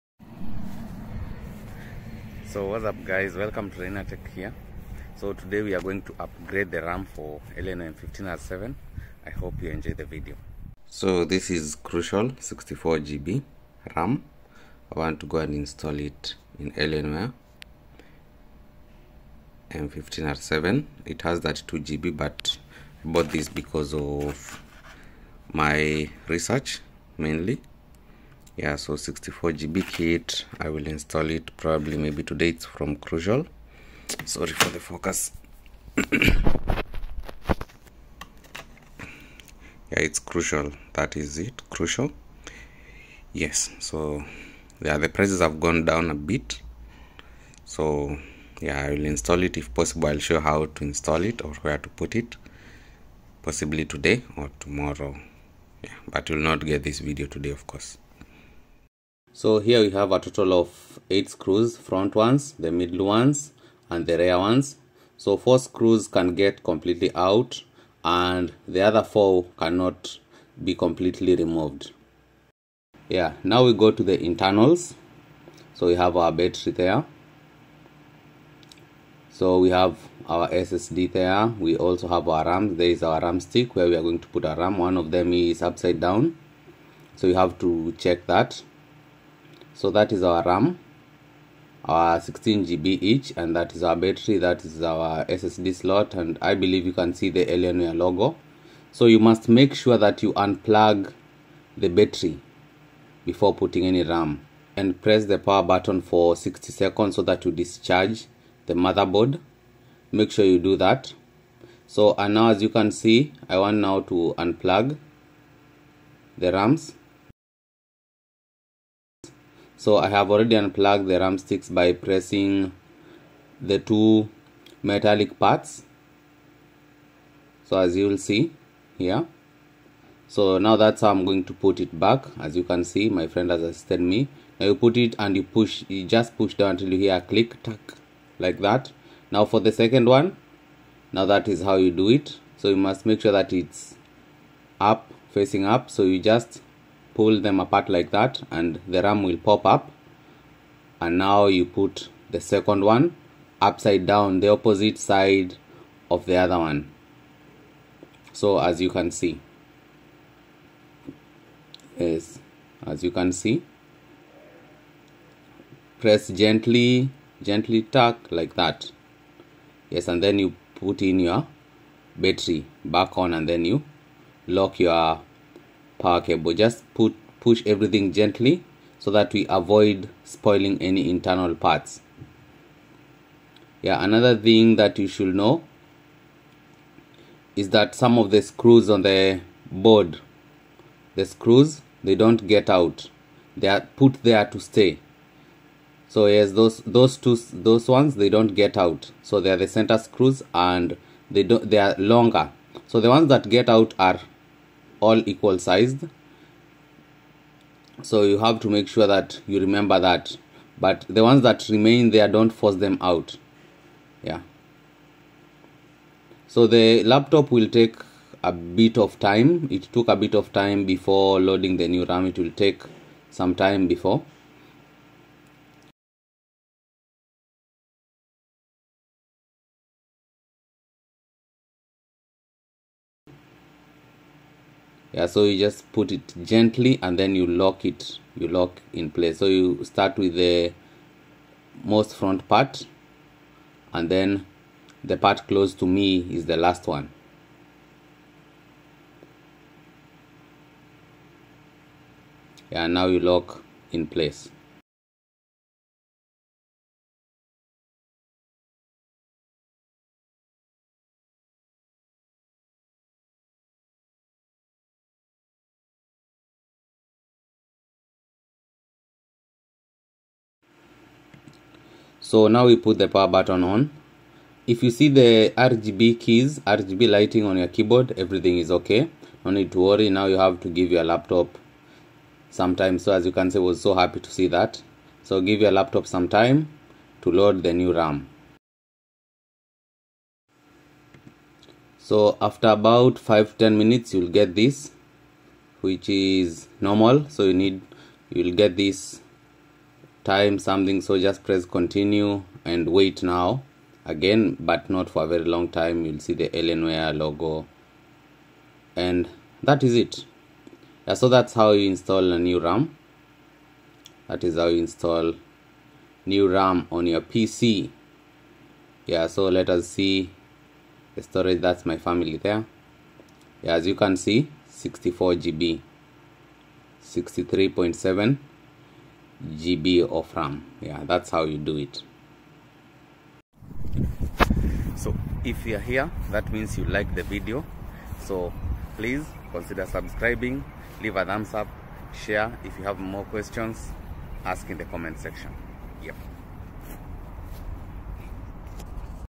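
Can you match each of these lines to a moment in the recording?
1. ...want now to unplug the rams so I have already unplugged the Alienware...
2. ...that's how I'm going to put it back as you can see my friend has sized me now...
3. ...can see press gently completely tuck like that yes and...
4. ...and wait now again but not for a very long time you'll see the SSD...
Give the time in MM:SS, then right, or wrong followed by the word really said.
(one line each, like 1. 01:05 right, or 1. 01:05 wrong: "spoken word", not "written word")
1. 01:53 wrong: "RAM", not "Alienware"
2. 02:10 wrong: "assisted", not "sized"
3. 02:43 wrong: "gently", not "completely"
4. 05:02 wrong: "Alienware", not "SSD".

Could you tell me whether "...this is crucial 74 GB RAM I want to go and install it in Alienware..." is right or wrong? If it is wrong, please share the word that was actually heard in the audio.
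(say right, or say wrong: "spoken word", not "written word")
wrong: "64", not "74".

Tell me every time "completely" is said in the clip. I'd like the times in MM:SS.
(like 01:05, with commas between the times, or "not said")
01:06, 01:10.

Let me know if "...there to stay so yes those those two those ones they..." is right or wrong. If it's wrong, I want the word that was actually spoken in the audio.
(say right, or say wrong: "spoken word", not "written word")
right.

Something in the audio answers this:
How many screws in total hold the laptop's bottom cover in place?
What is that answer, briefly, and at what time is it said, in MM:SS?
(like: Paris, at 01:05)
8, at 01:00.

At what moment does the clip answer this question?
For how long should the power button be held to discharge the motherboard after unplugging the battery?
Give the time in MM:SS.
01:46.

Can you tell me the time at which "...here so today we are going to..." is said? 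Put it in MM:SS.
00:04.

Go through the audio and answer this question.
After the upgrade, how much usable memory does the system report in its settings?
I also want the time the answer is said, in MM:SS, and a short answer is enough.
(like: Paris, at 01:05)
63.7 GB, at 05:27.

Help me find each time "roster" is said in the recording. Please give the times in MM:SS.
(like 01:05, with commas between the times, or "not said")
not said.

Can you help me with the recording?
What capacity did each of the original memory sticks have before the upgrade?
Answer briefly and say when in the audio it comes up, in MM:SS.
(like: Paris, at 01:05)
16 GB, at 01:32.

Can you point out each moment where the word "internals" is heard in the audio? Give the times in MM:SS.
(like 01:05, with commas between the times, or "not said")
01:14, 03:01.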